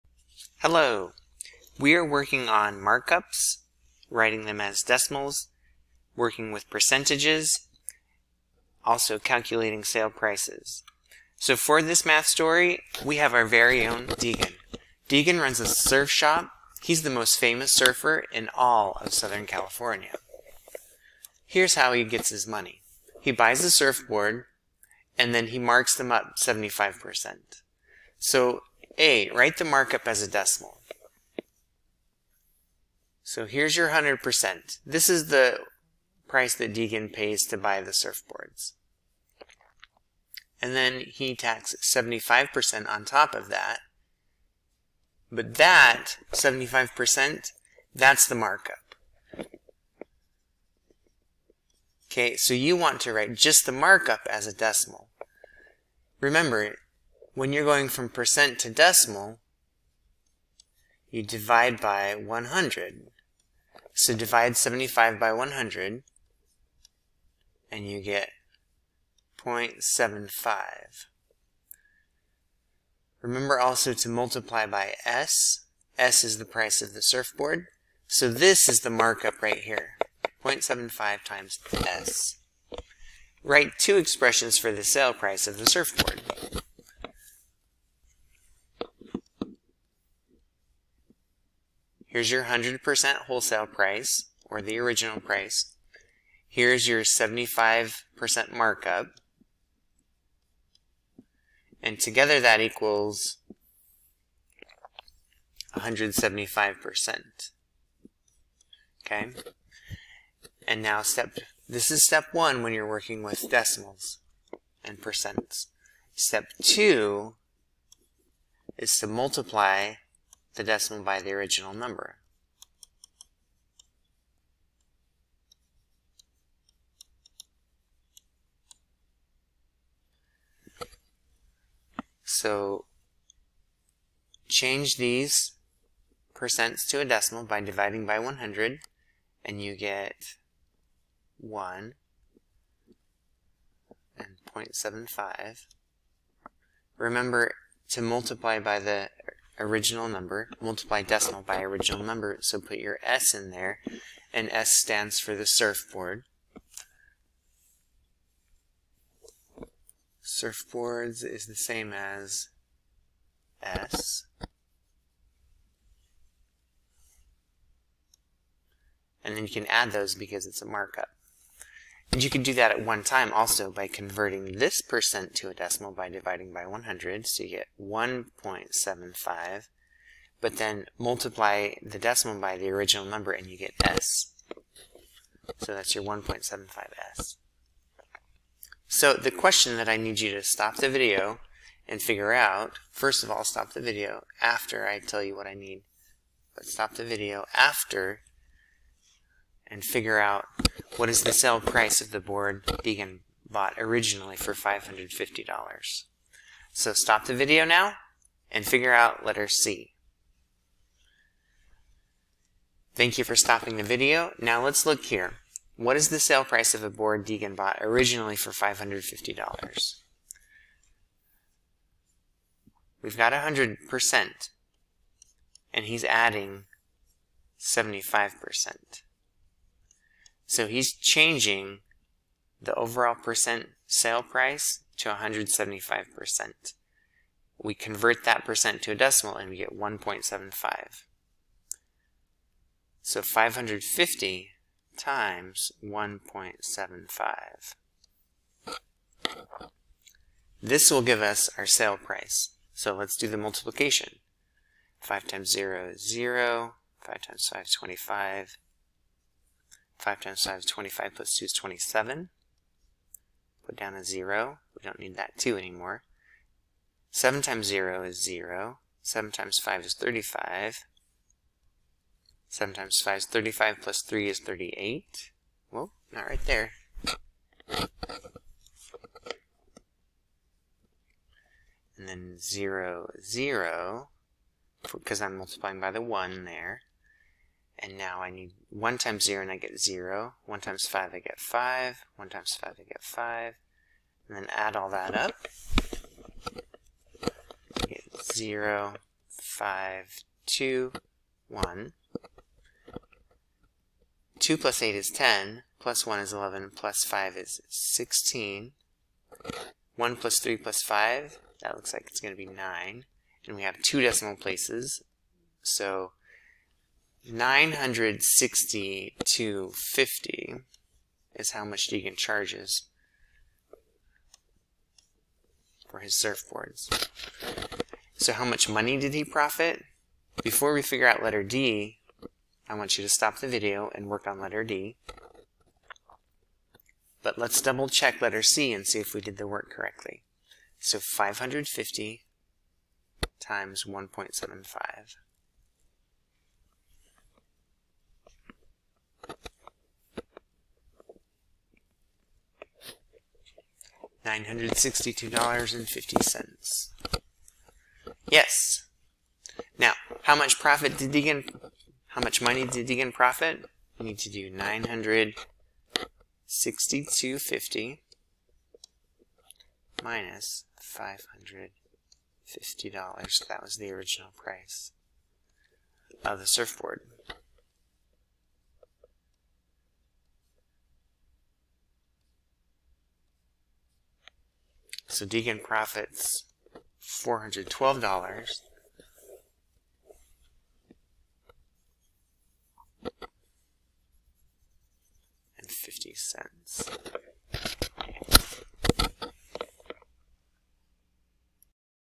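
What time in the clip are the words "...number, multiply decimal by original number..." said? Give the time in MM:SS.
02:30.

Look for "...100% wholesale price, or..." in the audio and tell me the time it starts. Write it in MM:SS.
01:32.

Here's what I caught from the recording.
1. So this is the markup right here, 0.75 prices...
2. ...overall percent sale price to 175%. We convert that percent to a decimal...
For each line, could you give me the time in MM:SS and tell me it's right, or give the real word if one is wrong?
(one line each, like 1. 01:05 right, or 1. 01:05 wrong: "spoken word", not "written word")
1. 01:18 wrong: "times", not "prices"
2. 03:52 right.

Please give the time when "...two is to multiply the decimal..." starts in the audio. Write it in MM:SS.
01:56.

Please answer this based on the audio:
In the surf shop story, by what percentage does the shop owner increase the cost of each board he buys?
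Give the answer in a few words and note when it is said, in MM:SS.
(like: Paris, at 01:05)
75%, at 00:25.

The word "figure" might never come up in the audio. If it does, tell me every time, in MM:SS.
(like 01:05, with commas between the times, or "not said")
03:12, 03:19, 03:28, 05:30.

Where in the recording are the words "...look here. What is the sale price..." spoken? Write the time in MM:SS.
03:34.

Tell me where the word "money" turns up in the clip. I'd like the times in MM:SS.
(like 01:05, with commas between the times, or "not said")
00:22, 05:28, 06:02.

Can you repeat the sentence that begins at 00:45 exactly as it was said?
But that 75%, that's the markup.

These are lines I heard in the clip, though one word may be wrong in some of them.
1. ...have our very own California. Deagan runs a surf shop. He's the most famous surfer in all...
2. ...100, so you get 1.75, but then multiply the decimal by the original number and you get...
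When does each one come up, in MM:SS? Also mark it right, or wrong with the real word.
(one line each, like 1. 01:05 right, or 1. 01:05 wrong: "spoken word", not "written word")
1. 00:13 wrong: "Deagan", not "California"
2. 02:56 right.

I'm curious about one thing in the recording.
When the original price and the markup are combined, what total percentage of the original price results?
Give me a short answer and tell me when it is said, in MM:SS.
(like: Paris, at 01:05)
175%, at 01:42.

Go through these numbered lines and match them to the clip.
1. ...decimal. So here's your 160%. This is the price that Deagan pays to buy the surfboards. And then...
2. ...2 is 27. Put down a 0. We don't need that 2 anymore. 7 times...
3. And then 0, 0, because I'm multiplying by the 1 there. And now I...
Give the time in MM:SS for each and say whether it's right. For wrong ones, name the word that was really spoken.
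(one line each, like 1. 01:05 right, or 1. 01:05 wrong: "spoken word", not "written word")
1. 00:30 wrong: "100", not "160"
2. 04:21 right
3. 04:41 right.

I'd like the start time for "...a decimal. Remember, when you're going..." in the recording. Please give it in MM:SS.
00:54.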